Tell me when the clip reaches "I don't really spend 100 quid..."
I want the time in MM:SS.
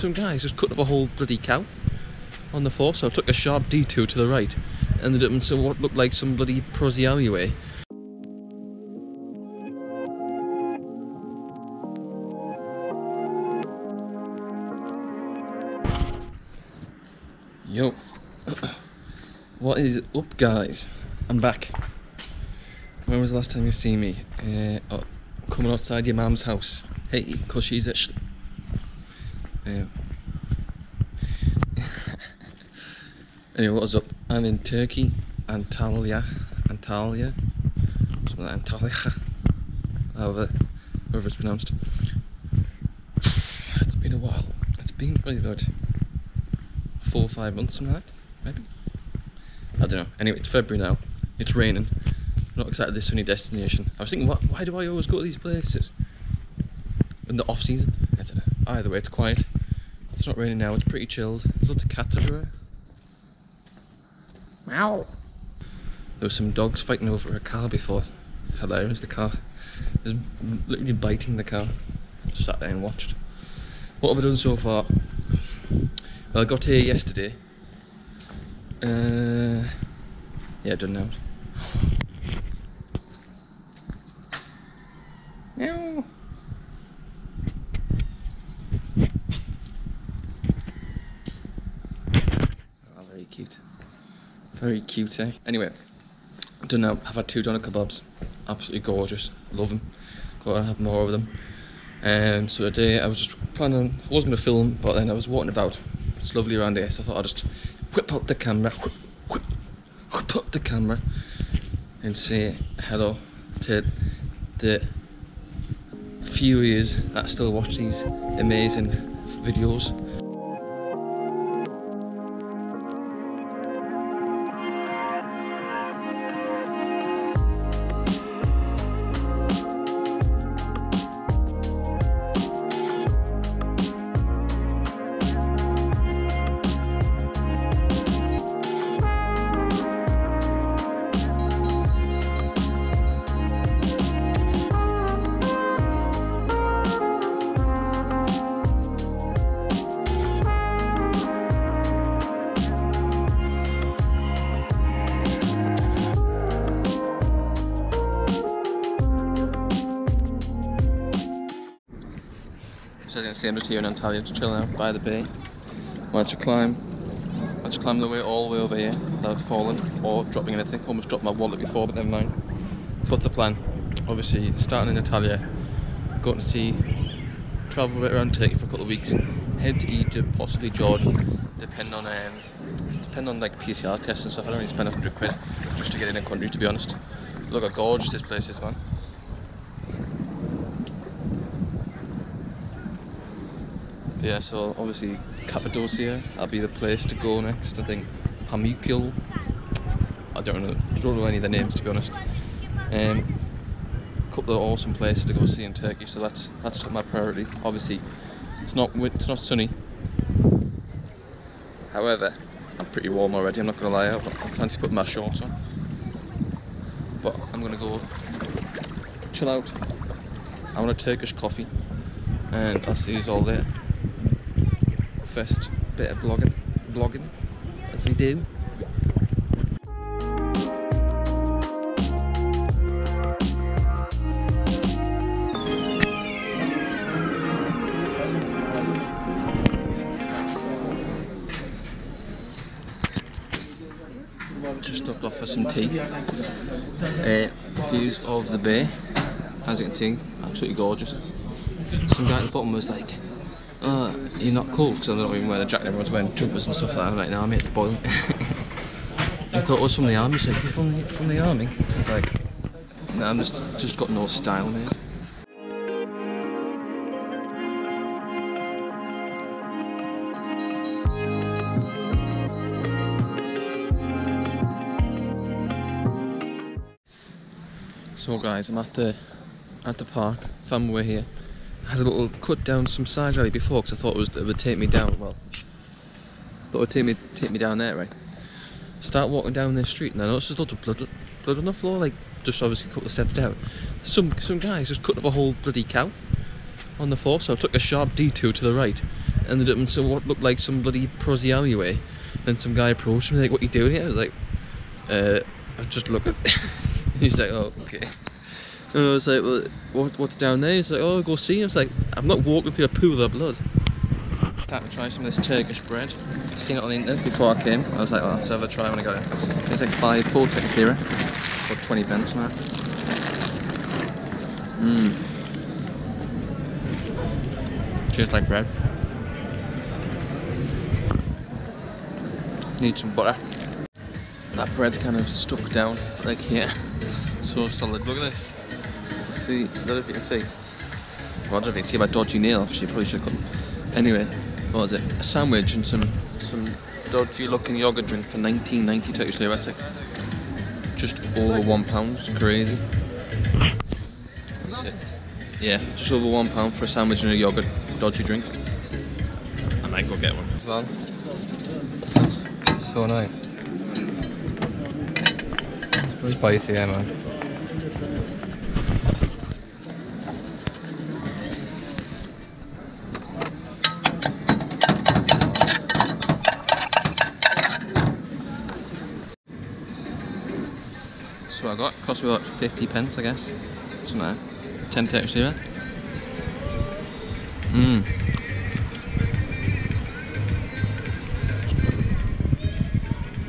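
03:04.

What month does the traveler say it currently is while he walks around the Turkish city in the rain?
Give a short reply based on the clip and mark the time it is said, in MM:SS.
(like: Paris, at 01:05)
February, at 00:50.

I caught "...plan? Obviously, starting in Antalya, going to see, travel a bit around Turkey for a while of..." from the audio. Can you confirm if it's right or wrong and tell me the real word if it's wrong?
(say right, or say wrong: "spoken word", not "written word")
wrong: "couple", not "while".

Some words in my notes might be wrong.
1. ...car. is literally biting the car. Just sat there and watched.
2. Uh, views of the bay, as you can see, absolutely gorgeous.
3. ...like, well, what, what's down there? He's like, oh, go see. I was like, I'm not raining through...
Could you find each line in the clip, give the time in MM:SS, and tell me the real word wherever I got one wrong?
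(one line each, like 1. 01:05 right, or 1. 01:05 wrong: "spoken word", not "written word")
1. 01:09 right
2. 04:05 right
3. 05:09 wrong: "walking", not "raining".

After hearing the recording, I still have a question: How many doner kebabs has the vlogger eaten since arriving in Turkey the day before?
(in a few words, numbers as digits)
2.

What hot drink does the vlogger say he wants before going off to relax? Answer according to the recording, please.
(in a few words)
Turkish coffee.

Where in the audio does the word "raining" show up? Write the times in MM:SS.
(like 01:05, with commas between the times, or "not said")
00:51, 01:00.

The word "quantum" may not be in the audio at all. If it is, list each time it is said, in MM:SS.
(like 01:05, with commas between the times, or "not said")
not said.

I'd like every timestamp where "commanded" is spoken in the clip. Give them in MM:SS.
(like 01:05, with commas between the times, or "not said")
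not said.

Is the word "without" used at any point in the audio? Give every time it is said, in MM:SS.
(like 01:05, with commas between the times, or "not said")
02:48.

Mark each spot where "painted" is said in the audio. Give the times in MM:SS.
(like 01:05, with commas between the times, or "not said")
not said.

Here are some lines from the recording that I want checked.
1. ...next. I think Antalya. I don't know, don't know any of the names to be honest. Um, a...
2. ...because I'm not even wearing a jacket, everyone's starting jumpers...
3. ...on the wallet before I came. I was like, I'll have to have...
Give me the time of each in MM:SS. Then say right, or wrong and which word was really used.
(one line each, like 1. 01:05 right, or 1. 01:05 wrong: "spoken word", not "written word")
1. 03:17 wrong: "Pamukkale", not "Antalya"
2. 04:14 wrong: "wearing", not "starting"
3. 05:16 wrong: "internet", not "wallet".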